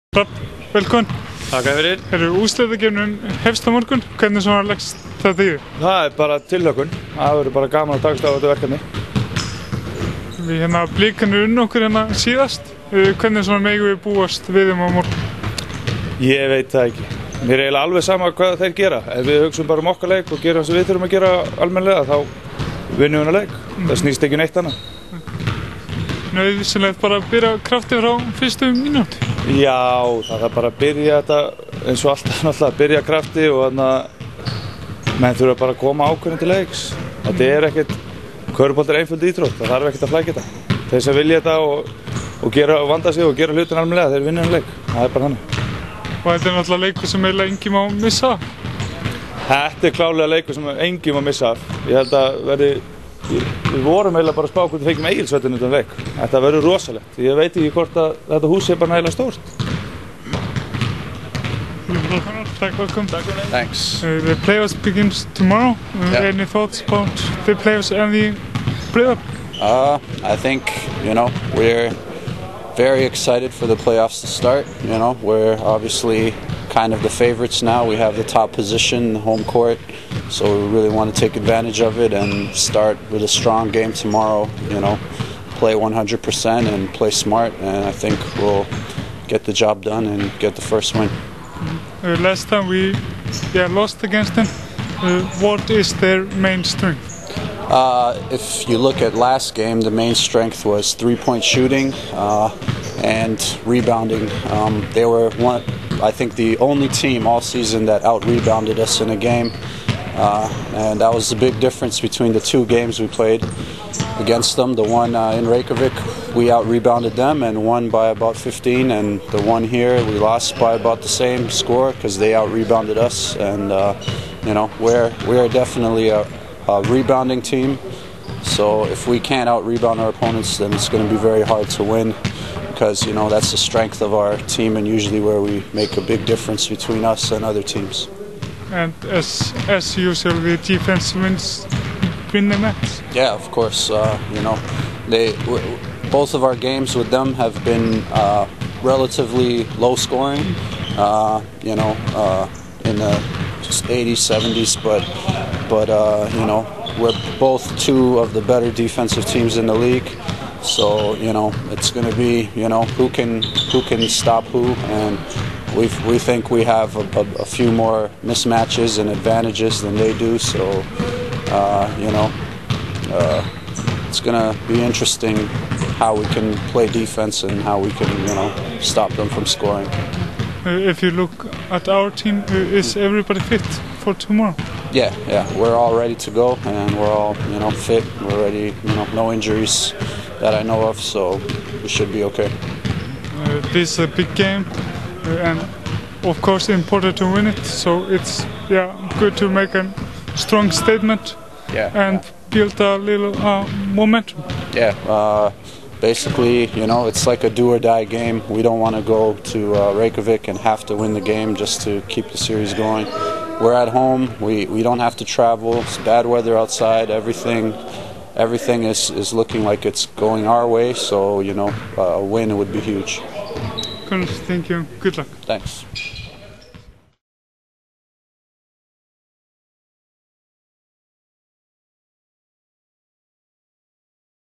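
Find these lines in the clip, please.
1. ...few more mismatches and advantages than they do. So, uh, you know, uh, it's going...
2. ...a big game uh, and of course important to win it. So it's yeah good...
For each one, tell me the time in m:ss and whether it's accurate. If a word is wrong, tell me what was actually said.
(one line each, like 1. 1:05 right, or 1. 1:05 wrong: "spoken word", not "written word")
1. 2:47 right
2. 3:13 right.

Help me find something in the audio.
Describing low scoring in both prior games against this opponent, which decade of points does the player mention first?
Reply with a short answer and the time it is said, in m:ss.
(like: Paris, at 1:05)
80s, at 2:33.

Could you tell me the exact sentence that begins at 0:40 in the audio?
Þeir sem vilja þetta og, og, gera, og vanda sig og gera hlutin almenlega, þeir vinna um leik.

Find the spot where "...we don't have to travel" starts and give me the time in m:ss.
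3:34.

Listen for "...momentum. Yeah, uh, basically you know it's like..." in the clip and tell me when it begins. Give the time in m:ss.
3:23.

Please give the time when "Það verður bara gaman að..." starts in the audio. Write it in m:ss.
0:07.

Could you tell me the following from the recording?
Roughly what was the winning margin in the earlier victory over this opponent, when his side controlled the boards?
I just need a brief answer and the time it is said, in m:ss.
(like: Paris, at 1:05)
15, at 1:58.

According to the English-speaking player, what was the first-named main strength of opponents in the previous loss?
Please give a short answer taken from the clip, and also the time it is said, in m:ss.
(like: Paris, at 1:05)
three-point shooting, at 1:40.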